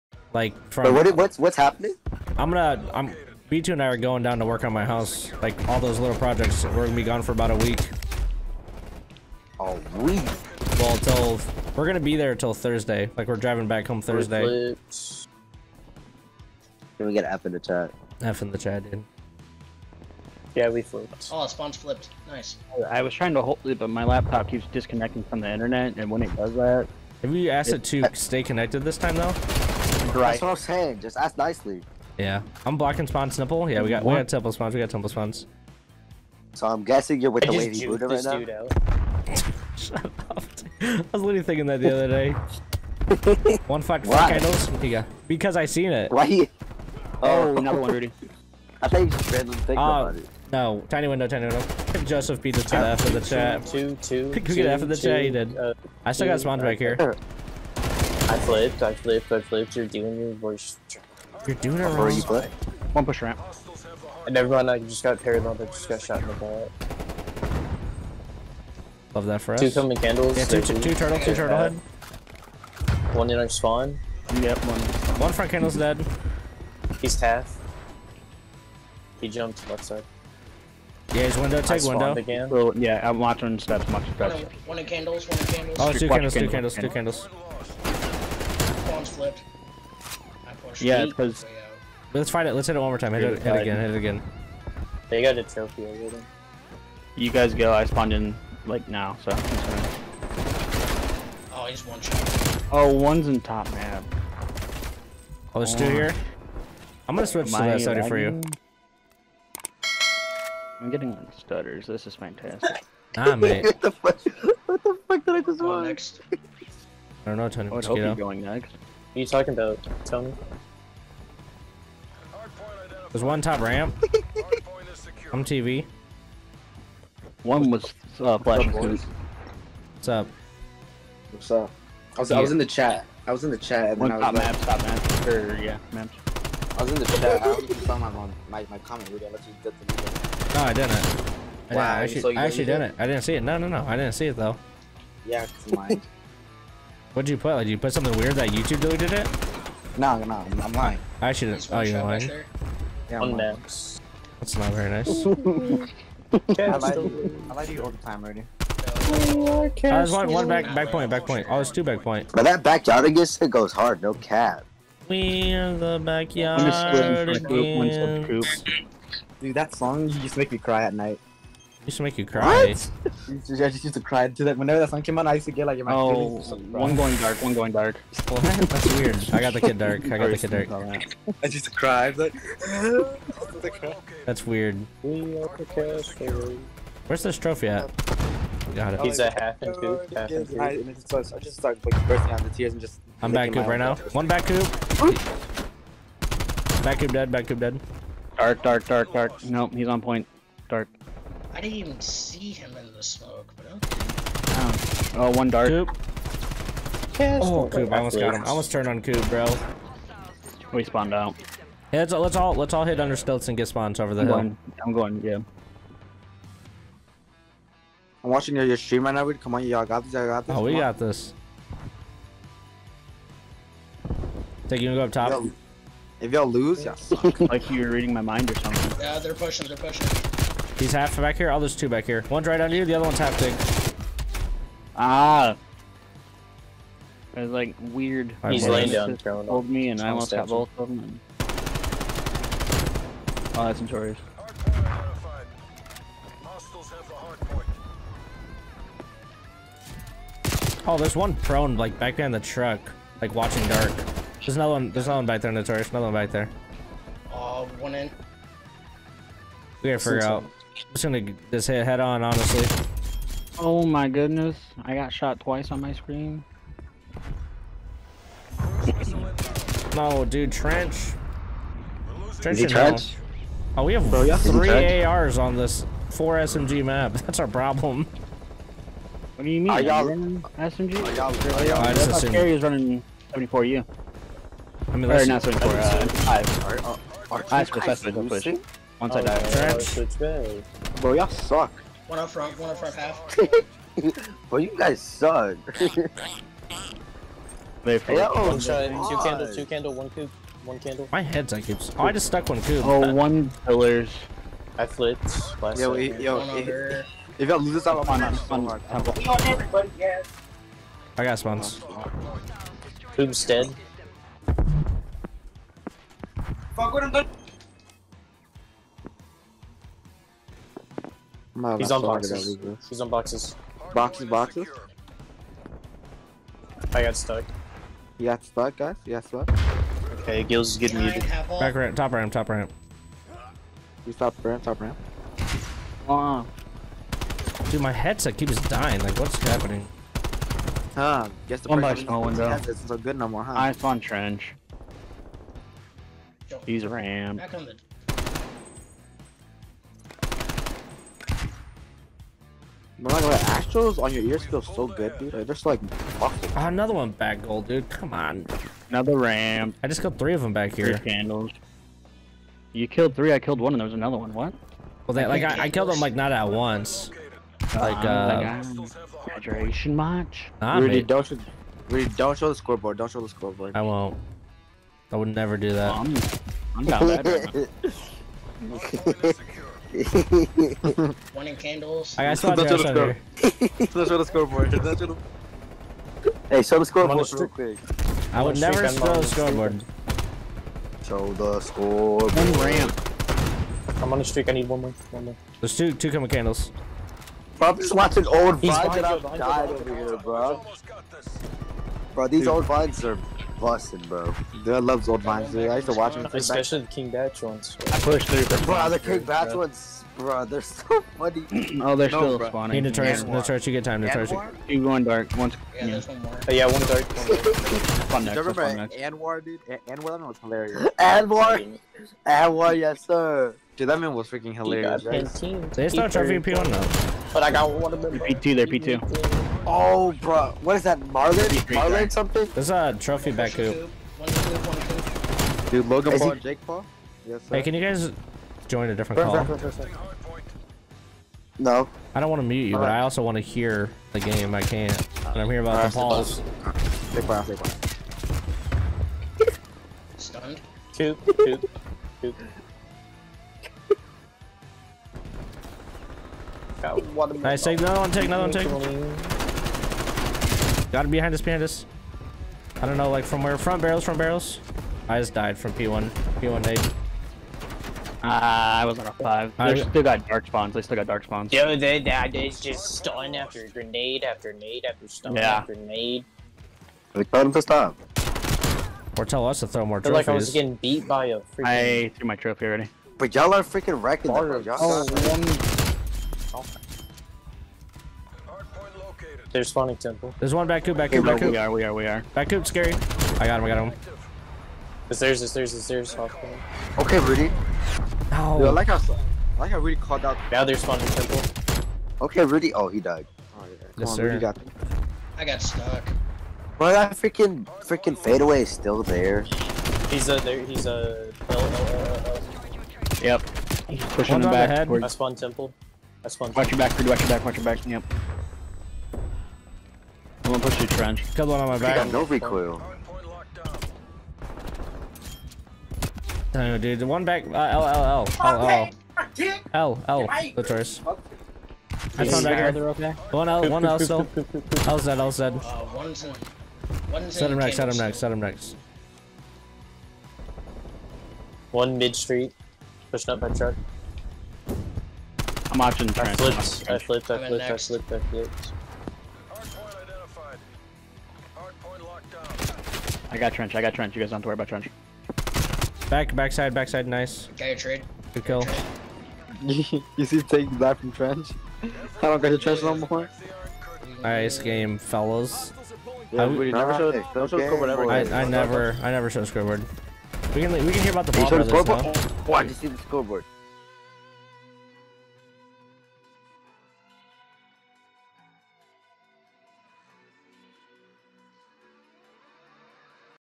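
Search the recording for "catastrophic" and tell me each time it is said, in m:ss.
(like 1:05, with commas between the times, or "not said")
not said.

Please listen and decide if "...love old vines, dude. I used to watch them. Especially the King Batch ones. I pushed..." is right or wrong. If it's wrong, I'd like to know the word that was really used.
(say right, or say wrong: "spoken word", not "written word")
right.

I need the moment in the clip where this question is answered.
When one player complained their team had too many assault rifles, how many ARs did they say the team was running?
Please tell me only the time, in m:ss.
4:34.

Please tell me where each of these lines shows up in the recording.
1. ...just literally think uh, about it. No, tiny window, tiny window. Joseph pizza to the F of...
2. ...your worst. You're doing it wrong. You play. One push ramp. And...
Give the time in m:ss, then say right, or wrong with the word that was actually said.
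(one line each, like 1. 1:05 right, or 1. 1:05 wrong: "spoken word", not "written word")
1. 0:49 wrong: "randomly", not "literally"
2. 1:00 right.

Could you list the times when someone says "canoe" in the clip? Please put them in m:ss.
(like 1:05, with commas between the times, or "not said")
not said.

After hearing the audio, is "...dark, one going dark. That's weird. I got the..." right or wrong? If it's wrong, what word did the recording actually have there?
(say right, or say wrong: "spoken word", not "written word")
right.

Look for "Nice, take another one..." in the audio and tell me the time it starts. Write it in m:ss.
7:37.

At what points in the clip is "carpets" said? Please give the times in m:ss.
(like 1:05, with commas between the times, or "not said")
not said.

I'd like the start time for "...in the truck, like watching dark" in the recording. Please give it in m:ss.
4:12.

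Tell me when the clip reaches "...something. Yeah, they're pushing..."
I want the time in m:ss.
3:48.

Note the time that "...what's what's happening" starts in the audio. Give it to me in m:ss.
0:01.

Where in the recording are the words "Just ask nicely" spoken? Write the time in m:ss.
0:30.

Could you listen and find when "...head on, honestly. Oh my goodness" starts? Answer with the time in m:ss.
4:21.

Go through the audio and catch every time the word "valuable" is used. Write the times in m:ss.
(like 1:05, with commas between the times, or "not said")
not said.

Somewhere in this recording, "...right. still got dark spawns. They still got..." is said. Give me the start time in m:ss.
7:49.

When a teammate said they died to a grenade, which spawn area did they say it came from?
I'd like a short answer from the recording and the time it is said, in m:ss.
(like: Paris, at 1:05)
P1, at 7:46.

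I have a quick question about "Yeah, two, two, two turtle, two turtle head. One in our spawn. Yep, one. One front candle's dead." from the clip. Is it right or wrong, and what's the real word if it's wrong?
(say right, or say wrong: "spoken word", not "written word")
right.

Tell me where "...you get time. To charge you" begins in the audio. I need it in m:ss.
6:53.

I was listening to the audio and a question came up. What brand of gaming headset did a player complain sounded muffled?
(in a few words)
Astros.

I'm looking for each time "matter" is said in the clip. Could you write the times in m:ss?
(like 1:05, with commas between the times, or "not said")
5:53.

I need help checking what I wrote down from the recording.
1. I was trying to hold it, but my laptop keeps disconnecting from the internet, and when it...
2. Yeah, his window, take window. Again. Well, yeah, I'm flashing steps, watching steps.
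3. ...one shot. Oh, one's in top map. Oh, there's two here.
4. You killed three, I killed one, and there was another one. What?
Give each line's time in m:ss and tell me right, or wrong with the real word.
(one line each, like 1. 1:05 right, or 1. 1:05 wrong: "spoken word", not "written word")
1. 0:22 right
2. 1:21 wrong: "watching", not "flashing"
3. 1:41 right
4. 6:02 right.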